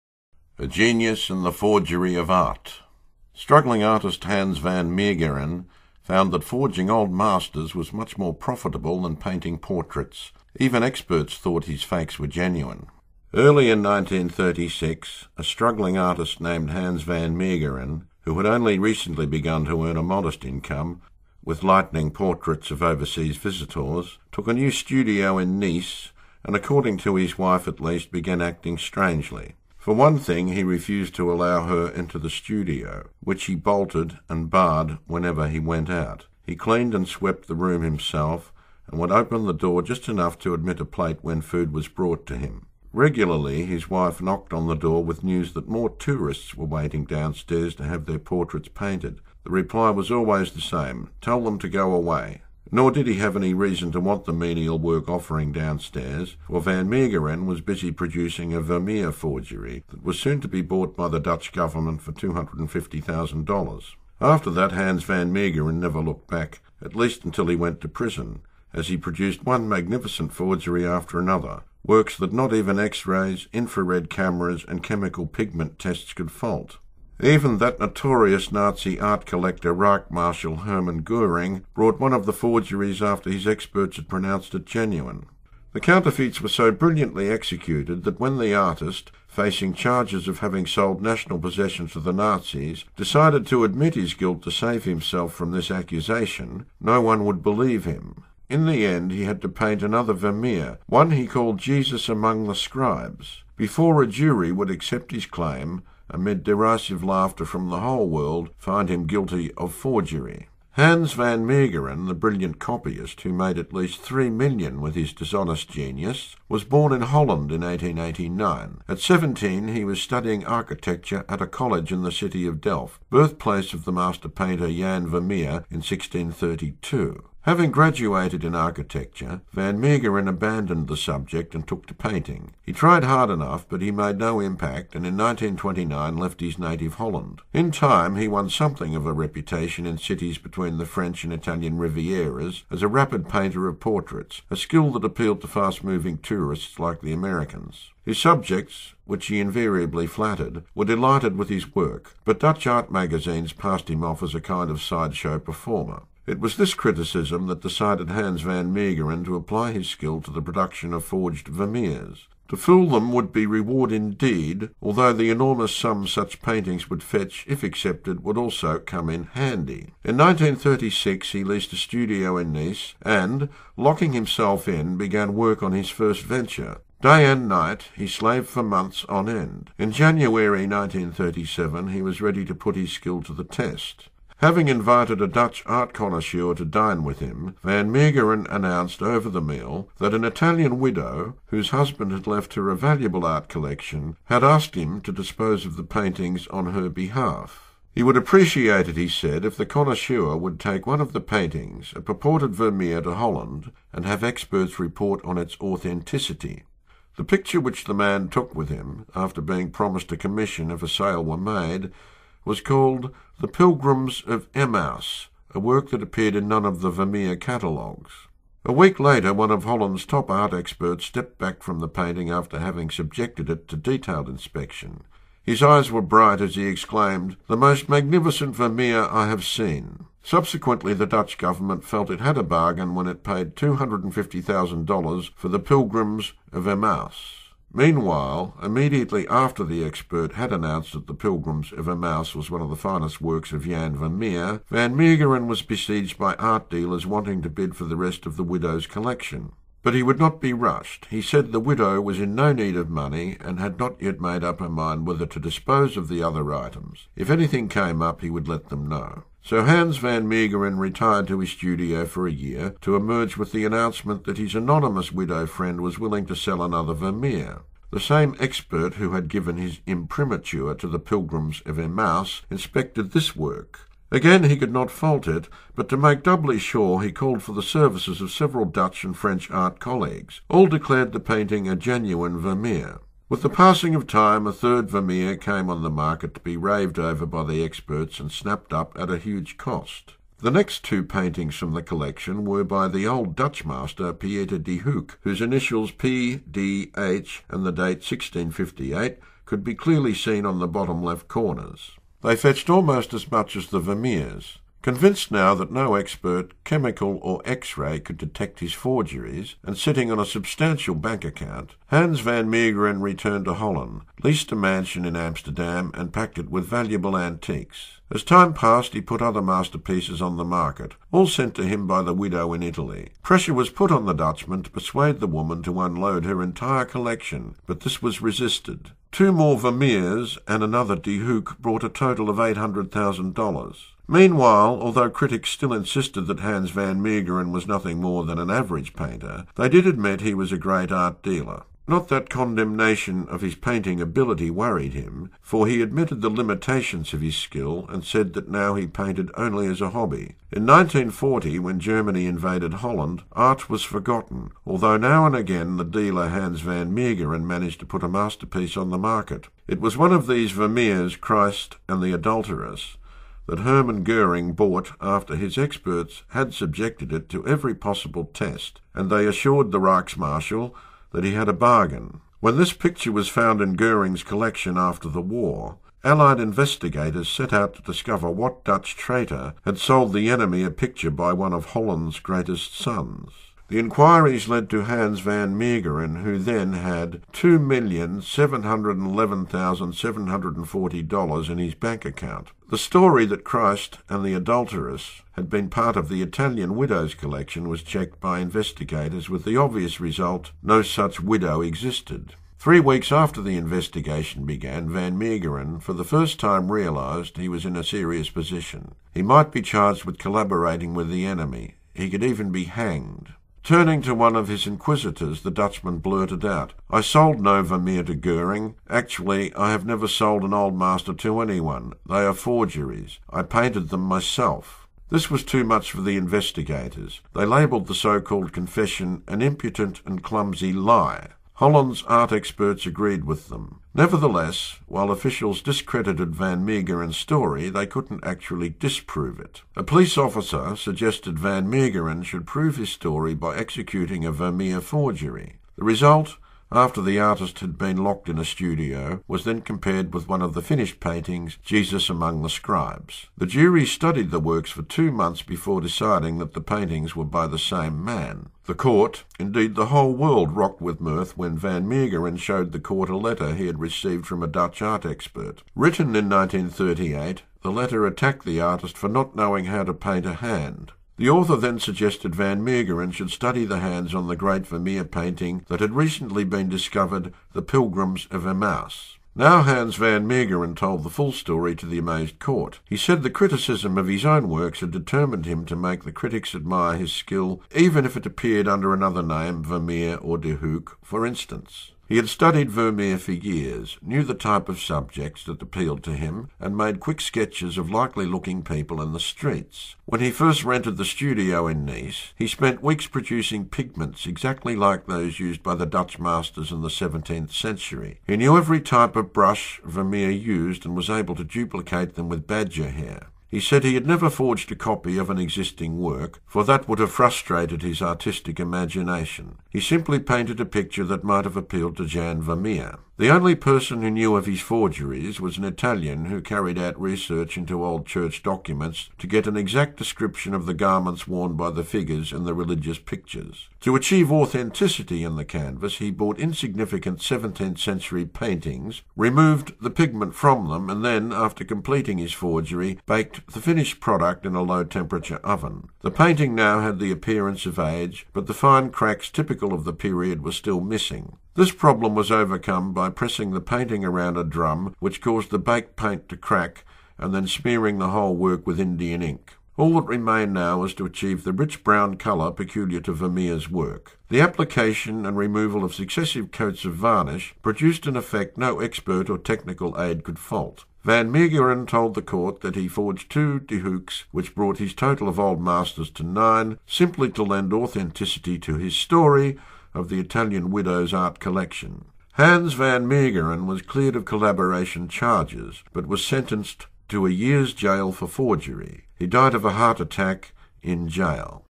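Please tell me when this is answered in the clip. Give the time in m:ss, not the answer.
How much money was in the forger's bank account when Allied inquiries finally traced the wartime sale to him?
6:27.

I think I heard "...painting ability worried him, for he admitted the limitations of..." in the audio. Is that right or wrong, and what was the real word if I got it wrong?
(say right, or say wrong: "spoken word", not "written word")
right.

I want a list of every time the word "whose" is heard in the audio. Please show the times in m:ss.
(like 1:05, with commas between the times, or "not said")
3:11, 4:55.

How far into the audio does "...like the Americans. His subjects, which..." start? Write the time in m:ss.
2:26.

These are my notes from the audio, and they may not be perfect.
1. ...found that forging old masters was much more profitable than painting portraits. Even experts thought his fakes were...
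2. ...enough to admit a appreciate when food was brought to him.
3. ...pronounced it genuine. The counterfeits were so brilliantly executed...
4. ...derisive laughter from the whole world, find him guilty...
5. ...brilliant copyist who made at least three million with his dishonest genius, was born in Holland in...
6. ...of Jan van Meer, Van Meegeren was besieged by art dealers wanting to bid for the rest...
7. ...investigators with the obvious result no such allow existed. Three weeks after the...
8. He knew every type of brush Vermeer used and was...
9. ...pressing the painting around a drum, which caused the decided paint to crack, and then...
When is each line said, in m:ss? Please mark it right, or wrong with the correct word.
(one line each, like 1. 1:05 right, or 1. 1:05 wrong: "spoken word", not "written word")
1. 0:06 right
2. 0:40 wrong: "plate", not "appreciate"
3. 1:24 right
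4. 1:46 right
5. 1:52 right
6. 4:03 right
7. 6:38 wrong: "widow", not "allow"
8. 8:28 right
9. 9:13 wrong: "baked", not "decided".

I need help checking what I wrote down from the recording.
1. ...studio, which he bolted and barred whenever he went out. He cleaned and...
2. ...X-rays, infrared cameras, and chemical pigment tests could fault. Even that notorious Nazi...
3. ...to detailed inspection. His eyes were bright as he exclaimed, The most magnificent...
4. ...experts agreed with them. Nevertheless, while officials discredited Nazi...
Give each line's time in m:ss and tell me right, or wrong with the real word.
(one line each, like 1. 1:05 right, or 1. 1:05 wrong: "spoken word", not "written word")
1. 0:32 right
2. 1:12 right
3. 3:43 right
4. 7:12 wrong: "Van", not "Nazi".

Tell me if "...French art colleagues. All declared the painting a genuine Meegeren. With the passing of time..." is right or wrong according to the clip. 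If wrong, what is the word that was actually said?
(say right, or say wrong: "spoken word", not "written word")
wrong: "Vermeer", not "Meegeren".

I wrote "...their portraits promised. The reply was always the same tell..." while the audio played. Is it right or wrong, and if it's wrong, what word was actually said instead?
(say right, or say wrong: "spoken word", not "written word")
wrong: "painted", not "promised".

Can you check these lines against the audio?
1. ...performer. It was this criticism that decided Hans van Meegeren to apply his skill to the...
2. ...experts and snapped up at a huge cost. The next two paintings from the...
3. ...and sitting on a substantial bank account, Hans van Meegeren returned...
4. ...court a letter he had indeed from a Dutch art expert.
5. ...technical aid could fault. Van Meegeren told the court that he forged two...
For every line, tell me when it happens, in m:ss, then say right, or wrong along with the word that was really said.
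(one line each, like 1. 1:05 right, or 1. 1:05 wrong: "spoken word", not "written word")
1. 2:35 right
2. 4:47 right
3. 5:09 right
4. 7:42 wrong: "received", not "indeed"
5. 9:29 right.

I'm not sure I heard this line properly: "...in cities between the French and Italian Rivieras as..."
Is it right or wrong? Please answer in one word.
right.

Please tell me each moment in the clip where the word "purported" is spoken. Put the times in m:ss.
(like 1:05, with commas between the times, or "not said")
3:22.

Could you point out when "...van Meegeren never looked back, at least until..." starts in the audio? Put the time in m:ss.
1:05.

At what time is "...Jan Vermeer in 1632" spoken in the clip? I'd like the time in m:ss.
2:04.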